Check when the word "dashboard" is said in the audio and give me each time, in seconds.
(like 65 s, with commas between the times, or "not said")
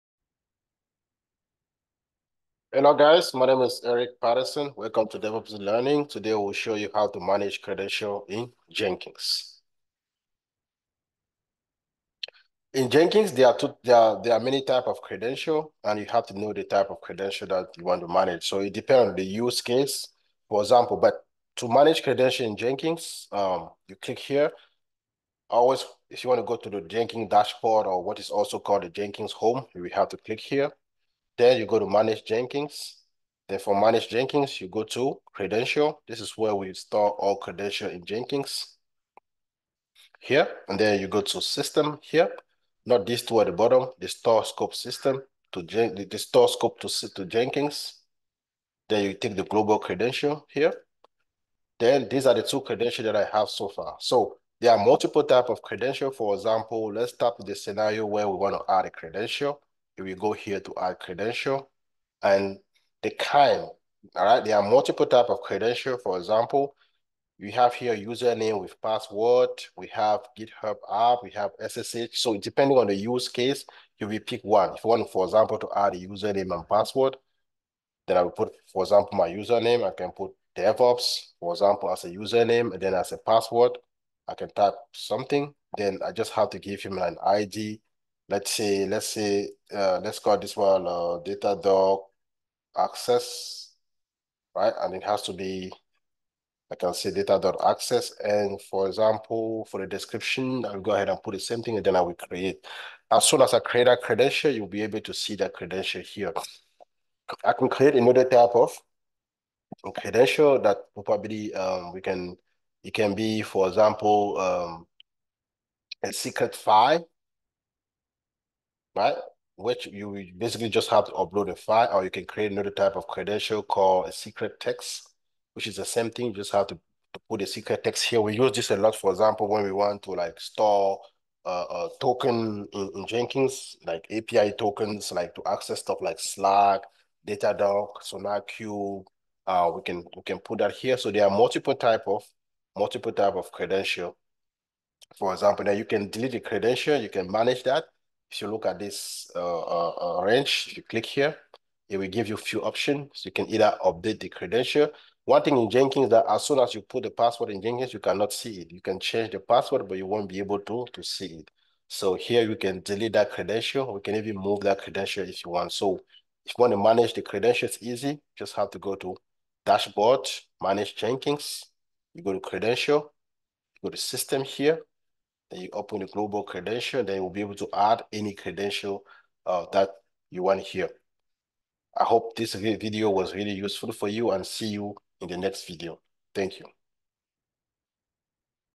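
27 s, 169 s.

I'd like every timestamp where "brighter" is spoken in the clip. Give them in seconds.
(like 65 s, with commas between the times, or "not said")
not said.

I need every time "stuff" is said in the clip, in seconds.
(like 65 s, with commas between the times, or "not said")
135 s.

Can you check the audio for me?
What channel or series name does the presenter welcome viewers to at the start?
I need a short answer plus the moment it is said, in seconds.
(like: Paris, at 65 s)
DevOps Learning, at 5 s.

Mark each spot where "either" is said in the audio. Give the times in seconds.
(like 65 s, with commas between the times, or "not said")
153 s.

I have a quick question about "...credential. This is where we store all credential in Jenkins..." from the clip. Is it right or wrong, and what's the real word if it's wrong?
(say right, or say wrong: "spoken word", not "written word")
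right.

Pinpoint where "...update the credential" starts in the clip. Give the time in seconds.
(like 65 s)
153 s.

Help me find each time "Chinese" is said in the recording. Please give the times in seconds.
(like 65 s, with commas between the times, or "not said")
not said.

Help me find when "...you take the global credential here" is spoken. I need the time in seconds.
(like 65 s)
49 s.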